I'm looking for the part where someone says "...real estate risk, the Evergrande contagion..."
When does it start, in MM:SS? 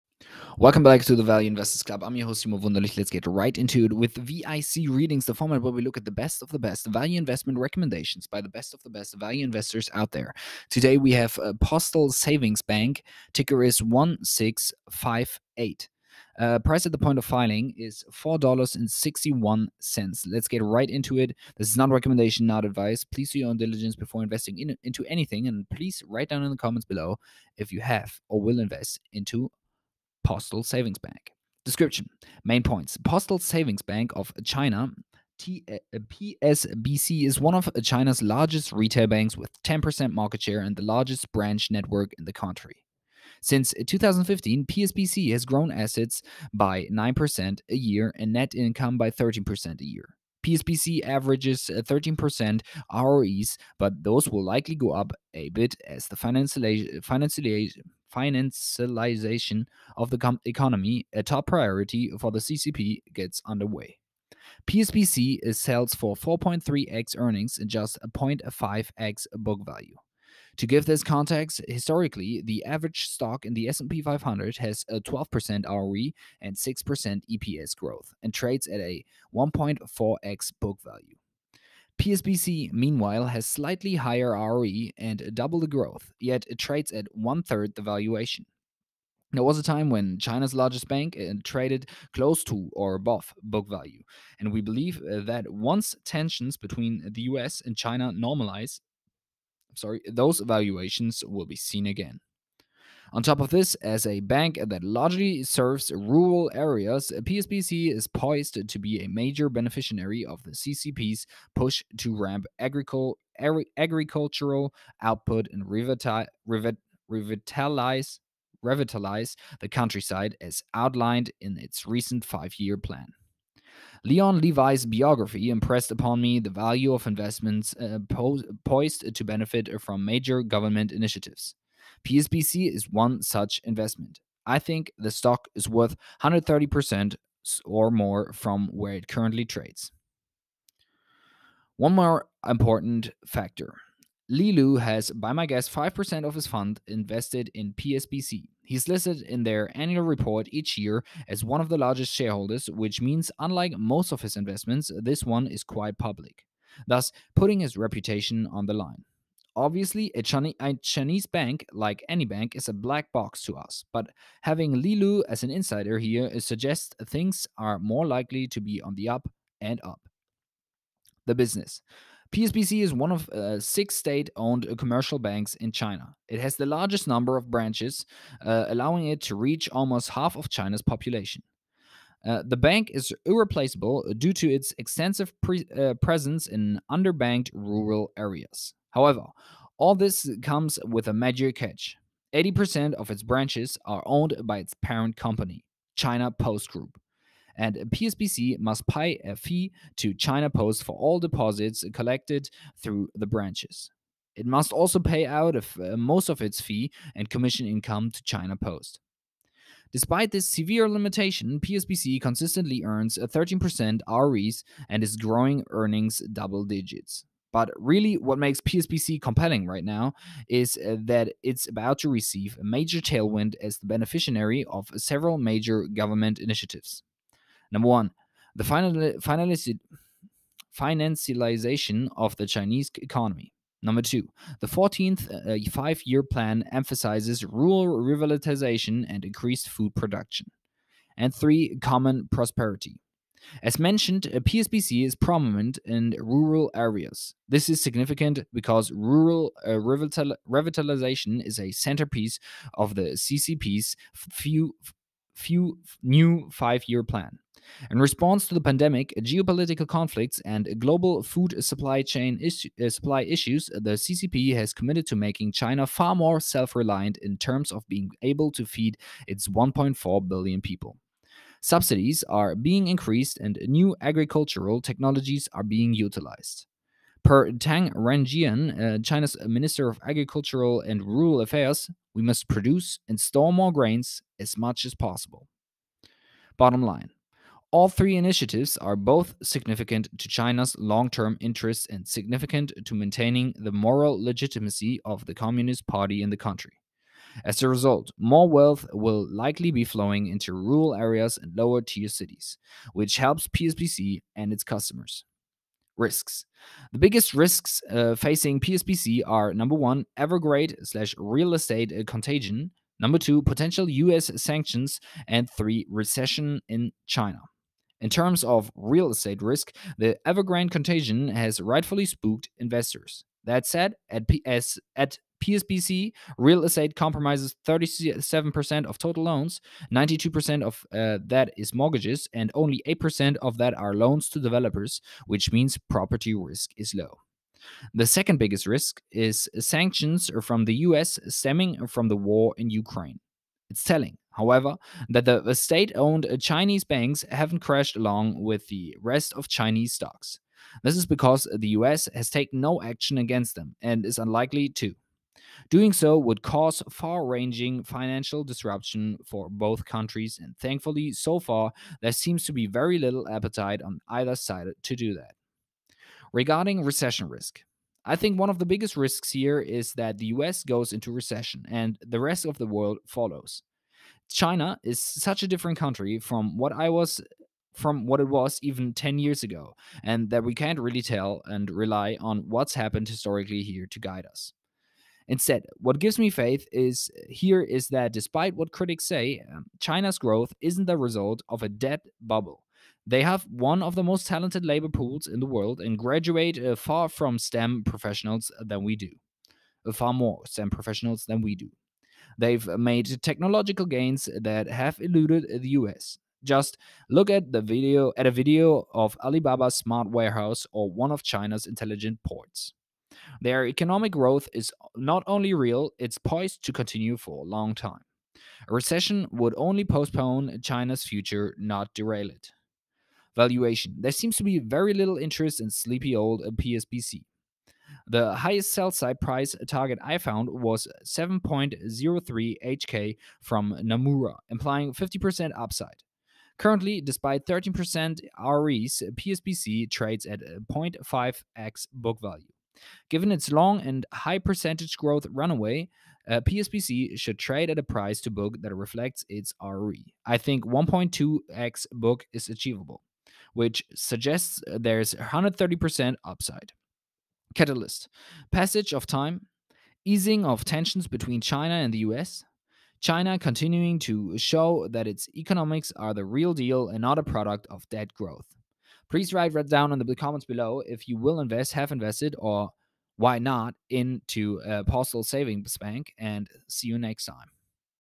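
05:18.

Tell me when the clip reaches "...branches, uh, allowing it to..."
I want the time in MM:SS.
02:57.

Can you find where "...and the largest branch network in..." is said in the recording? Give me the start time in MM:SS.
00:40.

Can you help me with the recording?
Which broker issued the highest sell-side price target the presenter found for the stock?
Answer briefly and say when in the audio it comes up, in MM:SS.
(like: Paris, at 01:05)
Nomura, at 07:13.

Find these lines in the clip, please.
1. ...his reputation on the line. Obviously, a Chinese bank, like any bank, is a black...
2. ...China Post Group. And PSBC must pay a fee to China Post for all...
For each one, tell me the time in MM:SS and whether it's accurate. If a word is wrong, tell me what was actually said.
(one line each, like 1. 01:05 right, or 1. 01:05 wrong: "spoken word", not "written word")
1. 02:37 right
2. 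03:15 right.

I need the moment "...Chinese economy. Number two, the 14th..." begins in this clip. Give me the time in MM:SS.
03:52.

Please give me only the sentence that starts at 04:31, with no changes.
Subsidies are being increased and new agricultural technologies are being utilized.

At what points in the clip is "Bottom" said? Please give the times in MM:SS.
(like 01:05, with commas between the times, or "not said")
04:46.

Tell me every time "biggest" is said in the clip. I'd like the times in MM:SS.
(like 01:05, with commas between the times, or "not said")
05:06, 05:38, 06:08.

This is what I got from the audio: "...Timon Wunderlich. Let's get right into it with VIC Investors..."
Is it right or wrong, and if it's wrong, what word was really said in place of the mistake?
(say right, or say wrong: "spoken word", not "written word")
wrong: "Readings", not "Investors".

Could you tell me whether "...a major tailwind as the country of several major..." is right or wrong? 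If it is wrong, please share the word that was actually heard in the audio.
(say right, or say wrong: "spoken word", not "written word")
wrong: "beneficiary", not "country".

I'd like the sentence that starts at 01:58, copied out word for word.
revitalize the countryside as outlined in its recent five-year plan.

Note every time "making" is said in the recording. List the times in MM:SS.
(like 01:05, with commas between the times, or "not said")
04:25.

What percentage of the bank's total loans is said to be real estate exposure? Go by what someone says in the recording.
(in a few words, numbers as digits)
37%.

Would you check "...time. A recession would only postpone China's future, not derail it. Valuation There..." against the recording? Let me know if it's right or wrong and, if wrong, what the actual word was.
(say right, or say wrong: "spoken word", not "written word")
right.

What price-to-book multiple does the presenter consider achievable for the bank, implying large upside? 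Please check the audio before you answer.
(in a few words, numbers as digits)
1.2x.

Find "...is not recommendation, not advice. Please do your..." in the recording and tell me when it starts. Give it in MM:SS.
00:21.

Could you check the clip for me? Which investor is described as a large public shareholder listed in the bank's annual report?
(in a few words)
Li Lu.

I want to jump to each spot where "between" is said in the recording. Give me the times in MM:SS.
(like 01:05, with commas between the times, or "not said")
01:36, 07:41.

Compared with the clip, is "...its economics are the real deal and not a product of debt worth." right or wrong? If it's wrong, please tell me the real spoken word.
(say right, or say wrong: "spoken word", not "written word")
wrong: "growth", not "worth".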